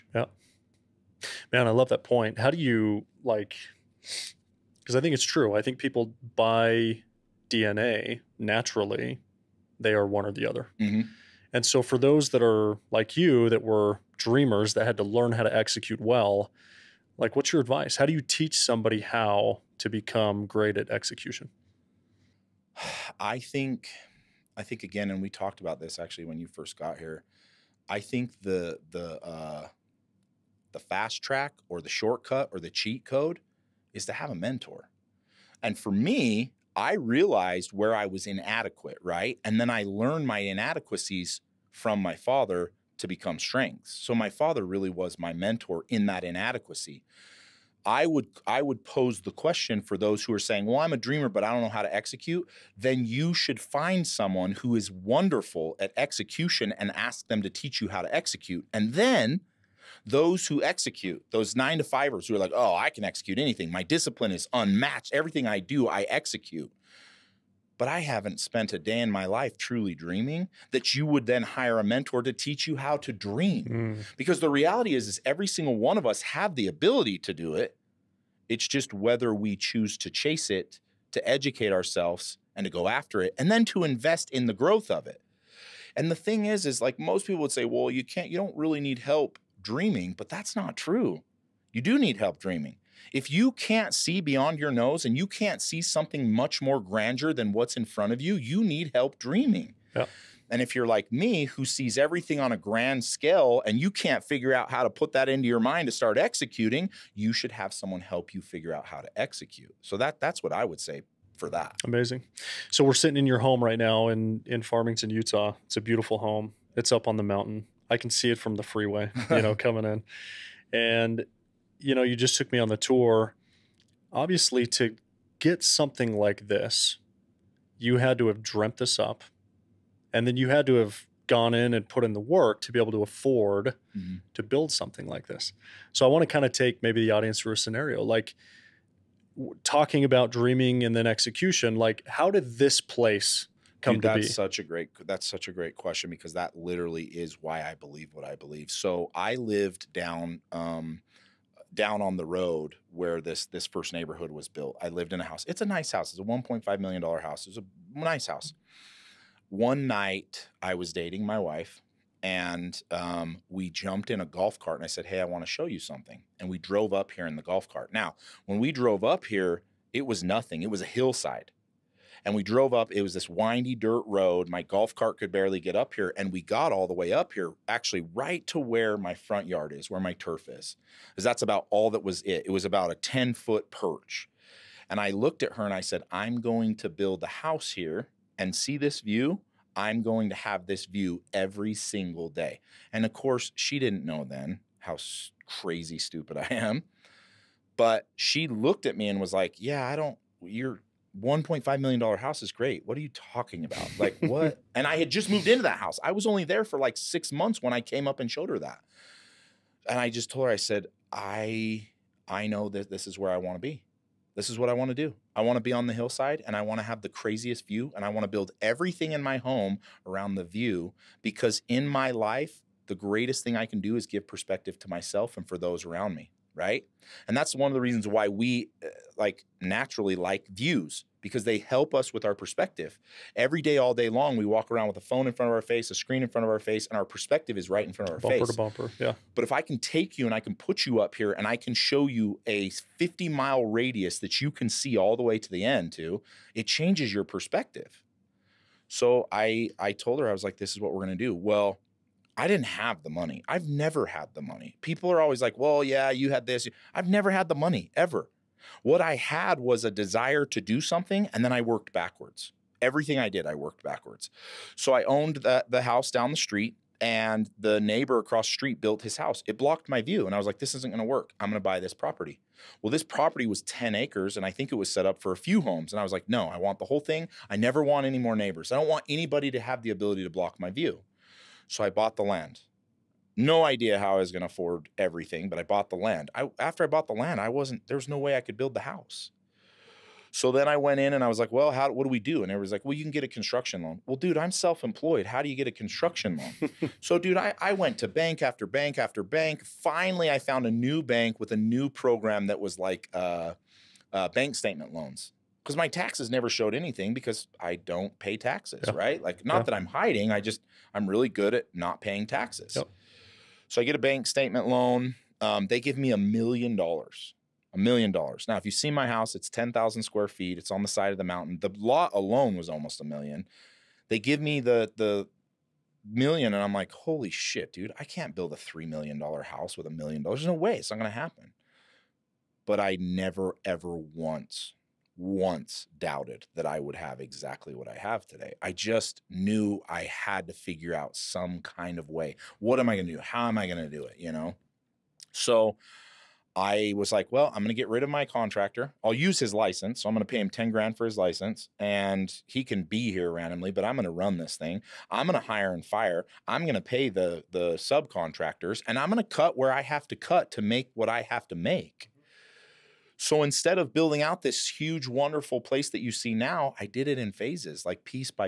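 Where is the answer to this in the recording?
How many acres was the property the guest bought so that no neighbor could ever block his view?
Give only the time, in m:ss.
4:33.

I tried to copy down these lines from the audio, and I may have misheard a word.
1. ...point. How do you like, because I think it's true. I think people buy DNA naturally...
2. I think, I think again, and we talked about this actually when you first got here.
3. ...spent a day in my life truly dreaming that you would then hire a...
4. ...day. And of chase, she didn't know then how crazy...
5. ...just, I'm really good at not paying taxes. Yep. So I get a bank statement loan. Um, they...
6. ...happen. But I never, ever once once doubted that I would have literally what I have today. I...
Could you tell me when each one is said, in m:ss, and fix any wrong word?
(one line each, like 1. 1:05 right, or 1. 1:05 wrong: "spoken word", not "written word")
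1. 0:02 right
2. 0:23 right
3. 1:08 right
4. 3:12 wrong: "course", not "chase"
5. 5:10 right
6. 5:31 wrong: "exactly", not "literally".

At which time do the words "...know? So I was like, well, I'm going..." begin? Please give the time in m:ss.
5:44.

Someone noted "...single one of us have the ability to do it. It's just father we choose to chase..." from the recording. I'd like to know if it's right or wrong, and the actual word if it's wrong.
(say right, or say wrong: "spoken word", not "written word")
wrong: "whether", not "father".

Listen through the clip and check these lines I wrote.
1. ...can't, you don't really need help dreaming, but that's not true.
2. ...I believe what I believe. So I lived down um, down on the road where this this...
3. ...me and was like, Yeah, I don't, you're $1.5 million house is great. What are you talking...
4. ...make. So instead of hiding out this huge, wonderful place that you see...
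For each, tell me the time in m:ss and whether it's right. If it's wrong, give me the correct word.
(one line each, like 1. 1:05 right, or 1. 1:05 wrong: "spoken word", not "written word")
1. 1:28 right
2. 2:27 right
3. 3:18 right
4. 6:01 wrong: "building", not "hiding".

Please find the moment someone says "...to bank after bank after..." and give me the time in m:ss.
4:57.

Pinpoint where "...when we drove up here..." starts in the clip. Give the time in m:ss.
2:48.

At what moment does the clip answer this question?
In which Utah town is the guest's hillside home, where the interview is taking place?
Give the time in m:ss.
1:54.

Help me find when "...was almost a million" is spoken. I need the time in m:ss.
5:22.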